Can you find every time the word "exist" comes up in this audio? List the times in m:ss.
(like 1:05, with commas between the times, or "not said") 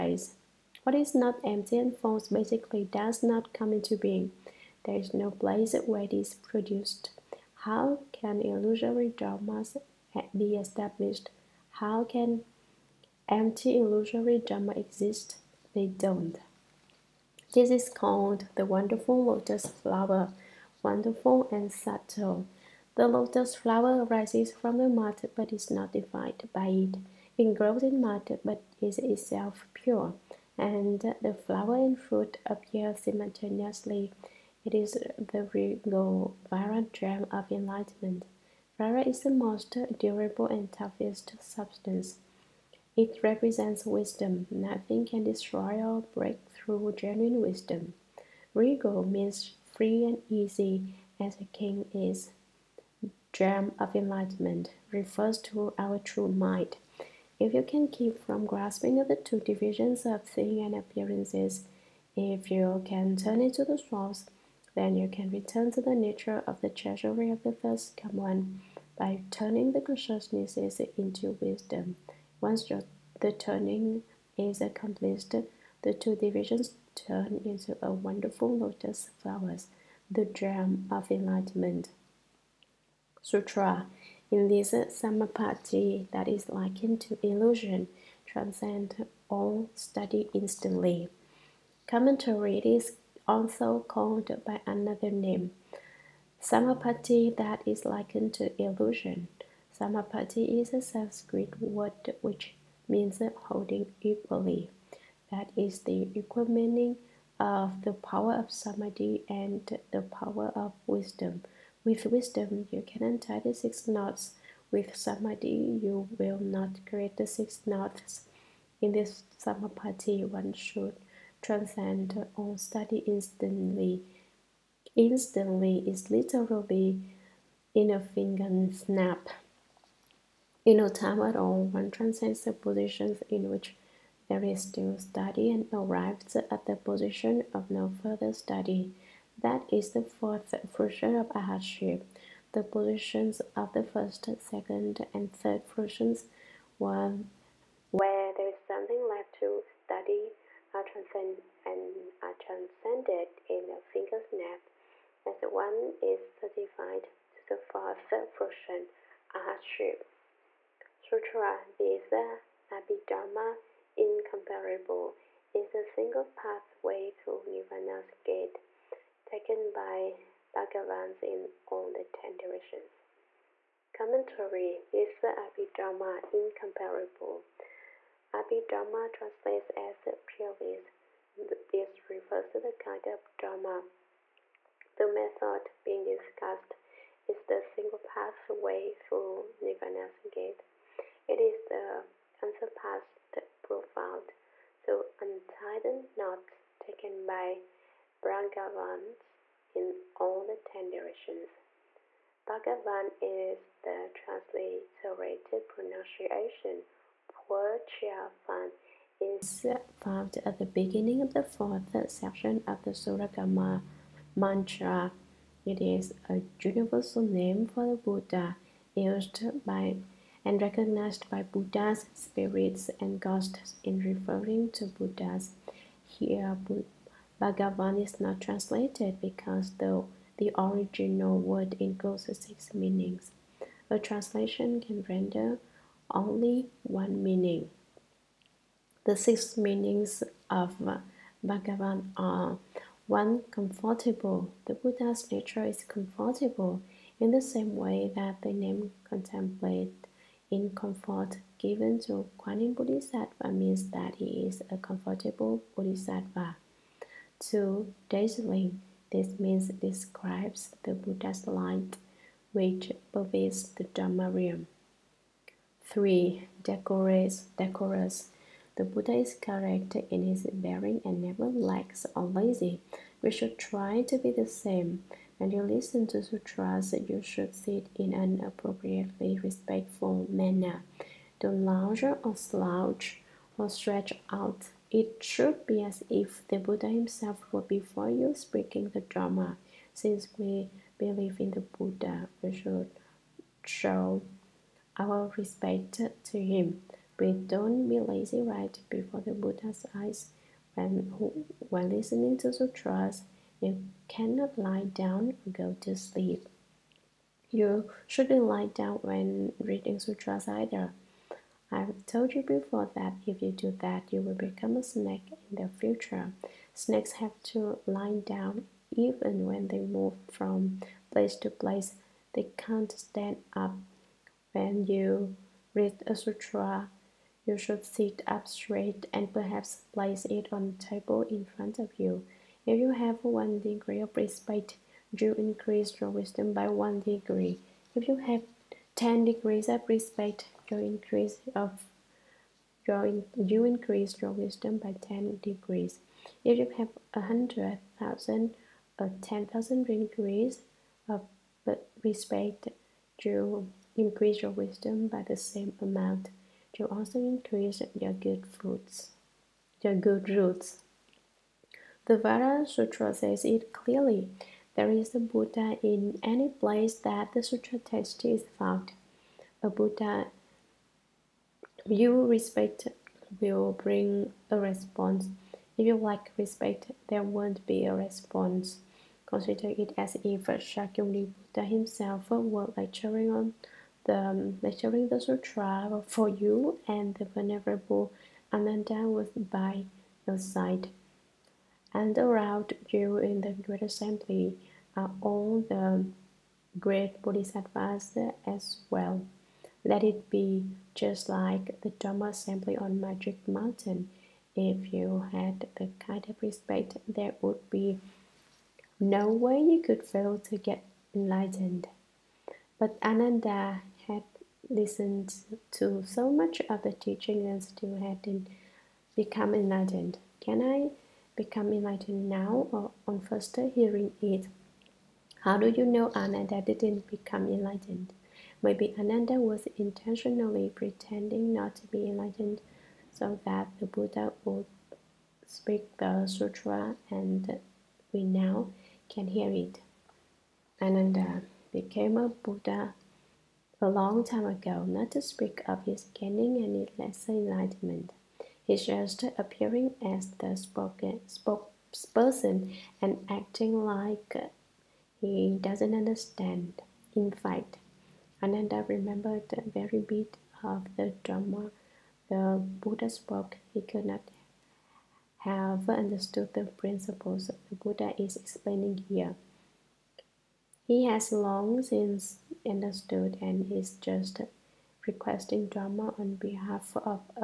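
0:14.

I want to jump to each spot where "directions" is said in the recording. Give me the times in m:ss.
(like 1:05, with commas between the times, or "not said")
2:52, 3:20.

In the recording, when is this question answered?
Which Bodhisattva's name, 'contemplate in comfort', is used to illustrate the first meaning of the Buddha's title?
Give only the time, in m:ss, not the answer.
4:12.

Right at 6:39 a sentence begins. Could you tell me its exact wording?
Let it be just like the Dharma Assembly on Magic Mountain.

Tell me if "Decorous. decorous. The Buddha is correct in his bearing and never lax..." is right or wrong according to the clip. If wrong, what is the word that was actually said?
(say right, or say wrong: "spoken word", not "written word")
right.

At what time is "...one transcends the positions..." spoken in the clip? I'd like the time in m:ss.
2:11.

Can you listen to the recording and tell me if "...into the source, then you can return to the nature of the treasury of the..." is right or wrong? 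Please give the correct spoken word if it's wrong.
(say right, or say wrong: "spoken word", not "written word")
right.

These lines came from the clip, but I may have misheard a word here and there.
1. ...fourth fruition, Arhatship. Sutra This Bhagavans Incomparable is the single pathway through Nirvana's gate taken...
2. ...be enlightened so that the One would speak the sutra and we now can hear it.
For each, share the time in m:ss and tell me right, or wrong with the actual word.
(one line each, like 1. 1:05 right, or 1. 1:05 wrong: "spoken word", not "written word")
1. 2:37 wrong: "Abhidharma", not "Bhagavans"
2. 7:11 wrong: "Buddha", not "One".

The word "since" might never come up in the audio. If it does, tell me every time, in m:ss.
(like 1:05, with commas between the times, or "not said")
4:49, 7:51.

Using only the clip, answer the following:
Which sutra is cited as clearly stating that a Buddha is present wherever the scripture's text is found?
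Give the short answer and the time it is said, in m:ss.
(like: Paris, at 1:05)
Vajra Sutra, at 6:02.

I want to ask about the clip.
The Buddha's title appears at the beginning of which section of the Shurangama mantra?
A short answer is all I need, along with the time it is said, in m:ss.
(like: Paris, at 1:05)
Fourth section, at 3:31.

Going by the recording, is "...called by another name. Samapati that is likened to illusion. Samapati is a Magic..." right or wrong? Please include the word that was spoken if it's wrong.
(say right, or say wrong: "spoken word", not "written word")
wrong: "Sanskrit", not "Magic".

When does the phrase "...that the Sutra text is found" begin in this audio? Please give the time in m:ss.
6:06.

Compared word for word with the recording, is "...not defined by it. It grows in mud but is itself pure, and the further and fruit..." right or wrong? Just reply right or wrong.
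wrong.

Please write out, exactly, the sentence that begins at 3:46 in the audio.
Here, Bhagavan is not translated because though the original word includes six meanings, a translation can render only one meaning.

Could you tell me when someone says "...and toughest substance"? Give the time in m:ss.
0:40.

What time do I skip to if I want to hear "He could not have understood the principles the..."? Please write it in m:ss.
7:43.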